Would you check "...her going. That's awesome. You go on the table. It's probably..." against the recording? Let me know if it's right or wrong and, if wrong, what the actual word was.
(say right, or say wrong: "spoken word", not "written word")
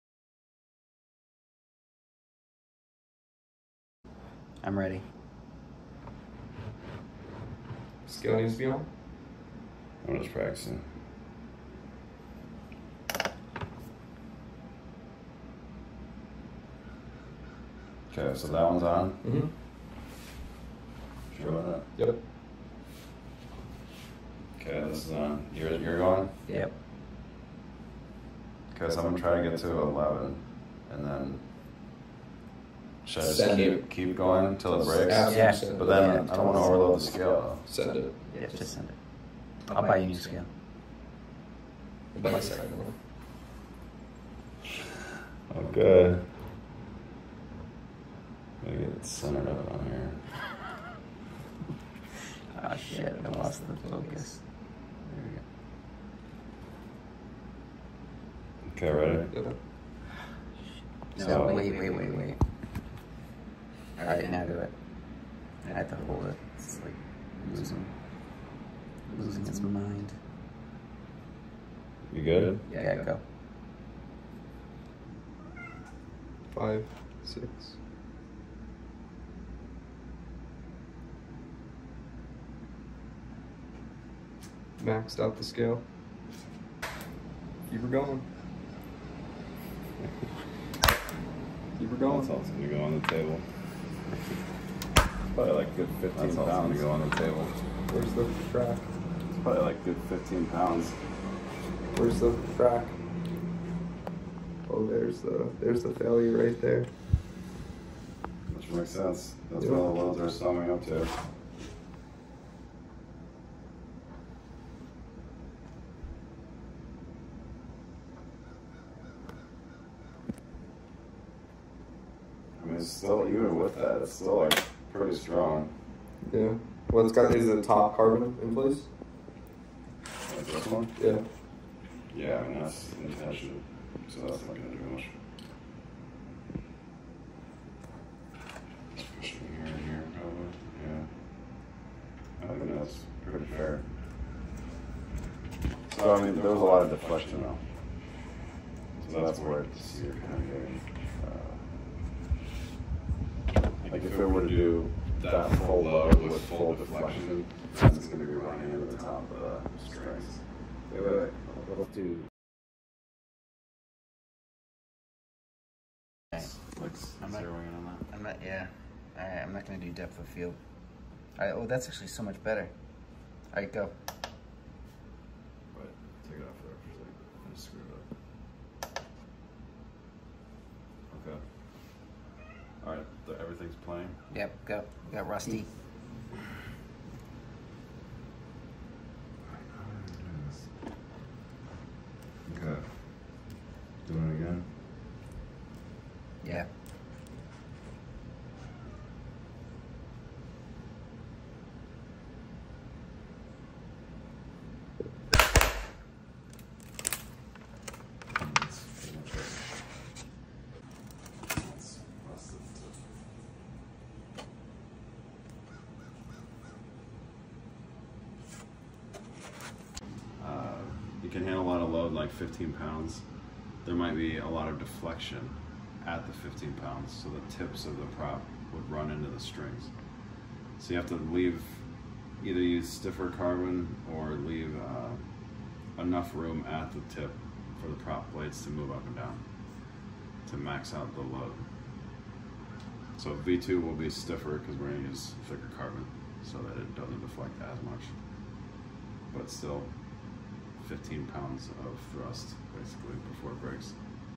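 right.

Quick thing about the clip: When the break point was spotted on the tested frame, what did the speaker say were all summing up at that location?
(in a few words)
welds.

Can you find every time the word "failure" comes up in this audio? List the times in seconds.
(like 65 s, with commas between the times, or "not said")
105 s.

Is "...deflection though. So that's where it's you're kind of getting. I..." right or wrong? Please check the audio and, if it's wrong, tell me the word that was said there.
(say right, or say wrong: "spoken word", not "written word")
right.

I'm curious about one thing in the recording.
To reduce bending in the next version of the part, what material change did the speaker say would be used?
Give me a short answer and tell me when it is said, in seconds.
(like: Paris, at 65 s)
thicker carbon, at 245 s.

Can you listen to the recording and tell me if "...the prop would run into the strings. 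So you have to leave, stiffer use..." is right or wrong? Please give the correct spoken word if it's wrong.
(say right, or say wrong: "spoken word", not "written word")
wrong: "either", not "stiffer".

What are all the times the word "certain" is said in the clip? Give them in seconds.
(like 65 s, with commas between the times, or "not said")
not said.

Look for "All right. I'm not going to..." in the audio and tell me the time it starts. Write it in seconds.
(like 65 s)
169 s.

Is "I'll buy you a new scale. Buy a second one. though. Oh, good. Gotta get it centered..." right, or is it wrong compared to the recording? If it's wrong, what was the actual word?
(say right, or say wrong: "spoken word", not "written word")
right.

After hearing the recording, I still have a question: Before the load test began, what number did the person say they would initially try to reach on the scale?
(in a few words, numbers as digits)
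11.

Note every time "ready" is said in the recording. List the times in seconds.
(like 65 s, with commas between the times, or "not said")
4 s, 58 s.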